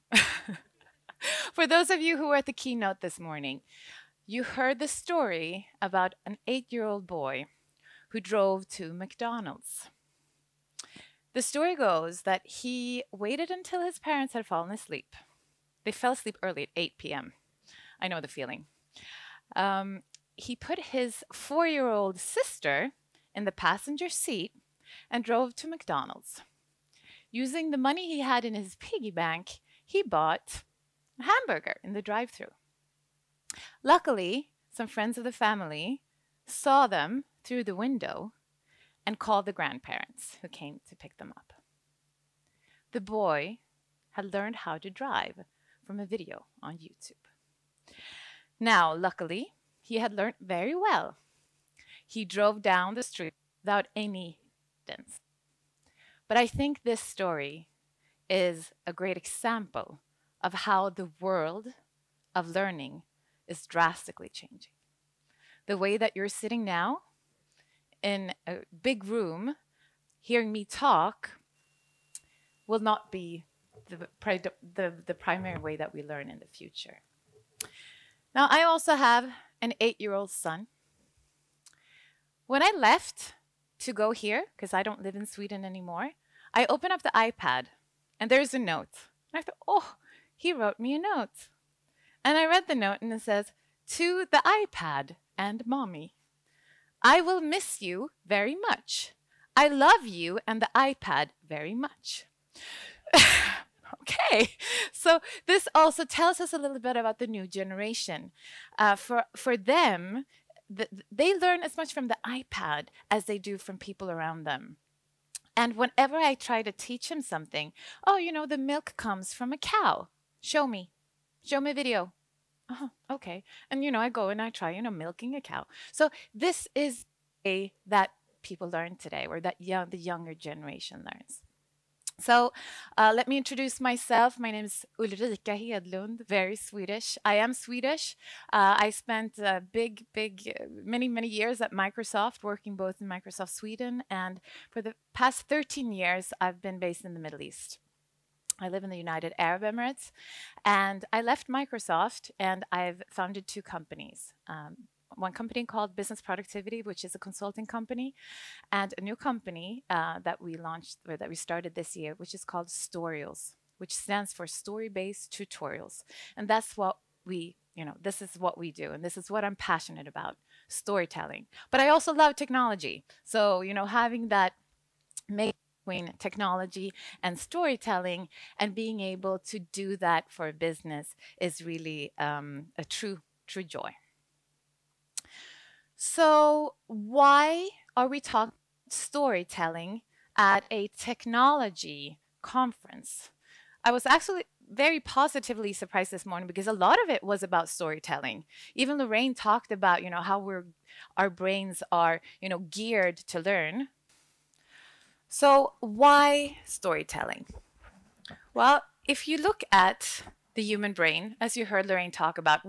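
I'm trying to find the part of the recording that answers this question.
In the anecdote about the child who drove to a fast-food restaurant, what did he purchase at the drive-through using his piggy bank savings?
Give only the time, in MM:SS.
00:31.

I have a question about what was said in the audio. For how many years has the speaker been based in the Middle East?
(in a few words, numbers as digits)
13.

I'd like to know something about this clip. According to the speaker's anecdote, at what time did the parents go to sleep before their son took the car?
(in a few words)
8 p.m.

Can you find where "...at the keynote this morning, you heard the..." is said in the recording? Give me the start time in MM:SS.
00:02.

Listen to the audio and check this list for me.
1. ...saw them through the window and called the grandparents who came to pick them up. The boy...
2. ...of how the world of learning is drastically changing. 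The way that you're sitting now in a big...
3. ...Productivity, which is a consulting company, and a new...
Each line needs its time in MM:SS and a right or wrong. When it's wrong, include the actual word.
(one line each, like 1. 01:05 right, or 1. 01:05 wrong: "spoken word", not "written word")
1. 00:36 right
2. 01:00 right
3. 02:36 right.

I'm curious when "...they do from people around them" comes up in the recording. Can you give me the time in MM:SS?
01:53.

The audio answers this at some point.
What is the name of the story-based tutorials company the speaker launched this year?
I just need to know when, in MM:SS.
02:42.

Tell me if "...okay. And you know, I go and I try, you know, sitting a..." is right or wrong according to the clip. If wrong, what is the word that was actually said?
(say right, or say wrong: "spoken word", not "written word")
wrong: "milking", not "sitting".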